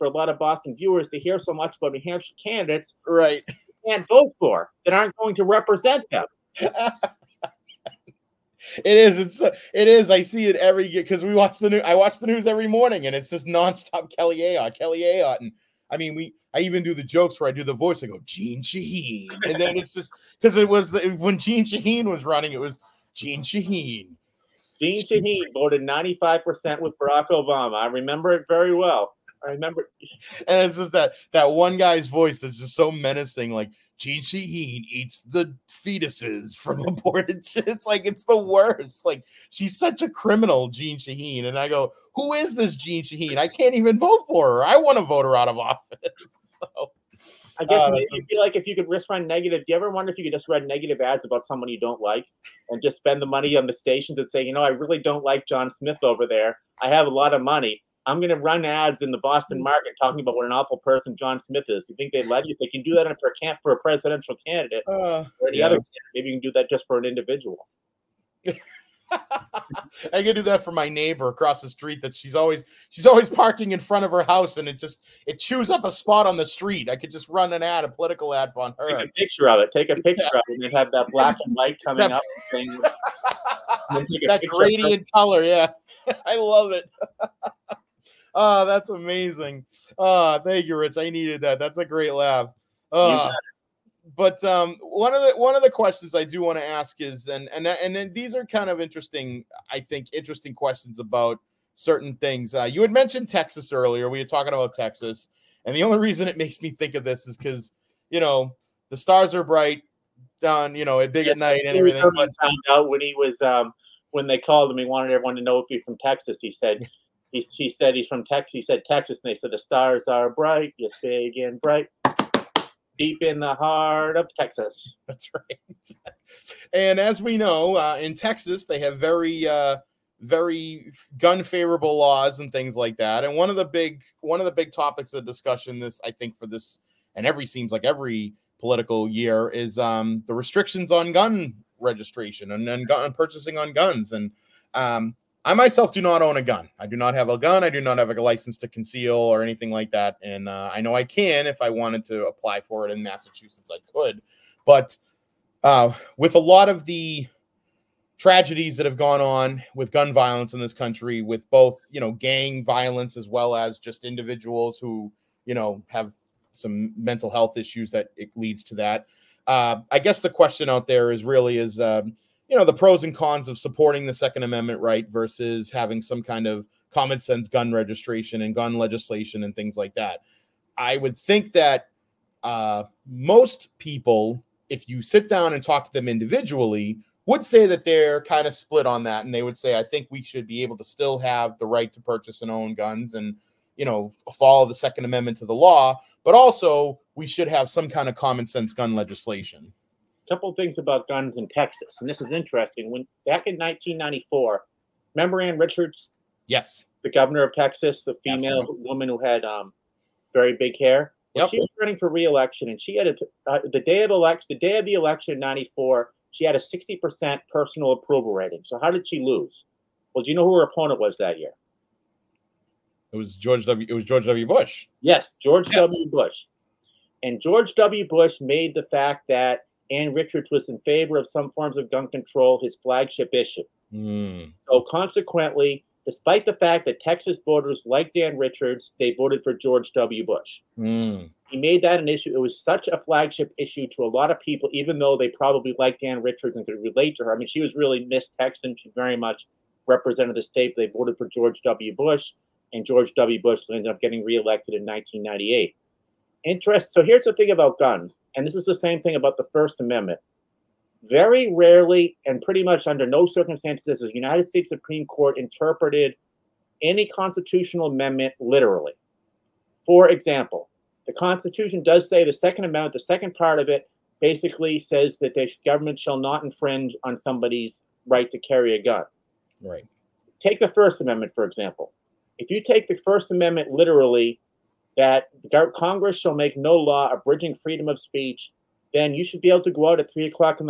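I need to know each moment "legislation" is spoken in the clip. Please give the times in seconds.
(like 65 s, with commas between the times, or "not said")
178 s, 198 s.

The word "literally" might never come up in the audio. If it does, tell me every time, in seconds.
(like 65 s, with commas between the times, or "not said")
268 s, 283 s.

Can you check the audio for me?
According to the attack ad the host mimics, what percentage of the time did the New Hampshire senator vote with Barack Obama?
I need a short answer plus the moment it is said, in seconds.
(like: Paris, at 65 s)
95%, at 25 s.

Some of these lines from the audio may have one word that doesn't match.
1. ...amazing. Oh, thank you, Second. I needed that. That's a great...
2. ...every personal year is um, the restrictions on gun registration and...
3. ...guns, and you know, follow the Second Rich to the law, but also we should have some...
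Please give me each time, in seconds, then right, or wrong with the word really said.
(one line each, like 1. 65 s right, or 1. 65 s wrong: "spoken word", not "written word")
1. 88 s wrong: "Rich", not "Second"
2. 137 s wrong: "political", not "personal"
3. 192 s wrong: "Amendment", not "Rich".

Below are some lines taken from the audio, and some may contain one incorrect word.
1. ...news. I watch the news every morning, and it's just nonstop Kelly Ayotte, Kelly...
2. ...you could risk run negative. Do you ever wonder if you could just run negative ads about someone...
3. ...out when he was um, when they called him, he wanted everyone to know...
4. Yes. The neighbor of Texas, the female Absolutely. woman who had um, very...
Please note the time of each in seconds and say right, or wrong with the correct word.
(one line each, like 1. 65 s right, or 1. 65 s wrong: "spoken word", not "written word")
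1. 11 s right
2. 48 s right
3. 112 s right
4. 206 s wrong: "governor", not "neighbor".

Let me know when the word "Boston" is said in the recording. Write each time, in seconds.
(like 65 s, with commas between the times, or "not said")
0 s, 59 s.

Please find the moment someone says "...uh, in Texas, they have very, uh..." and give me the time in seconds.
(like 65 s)
127 s.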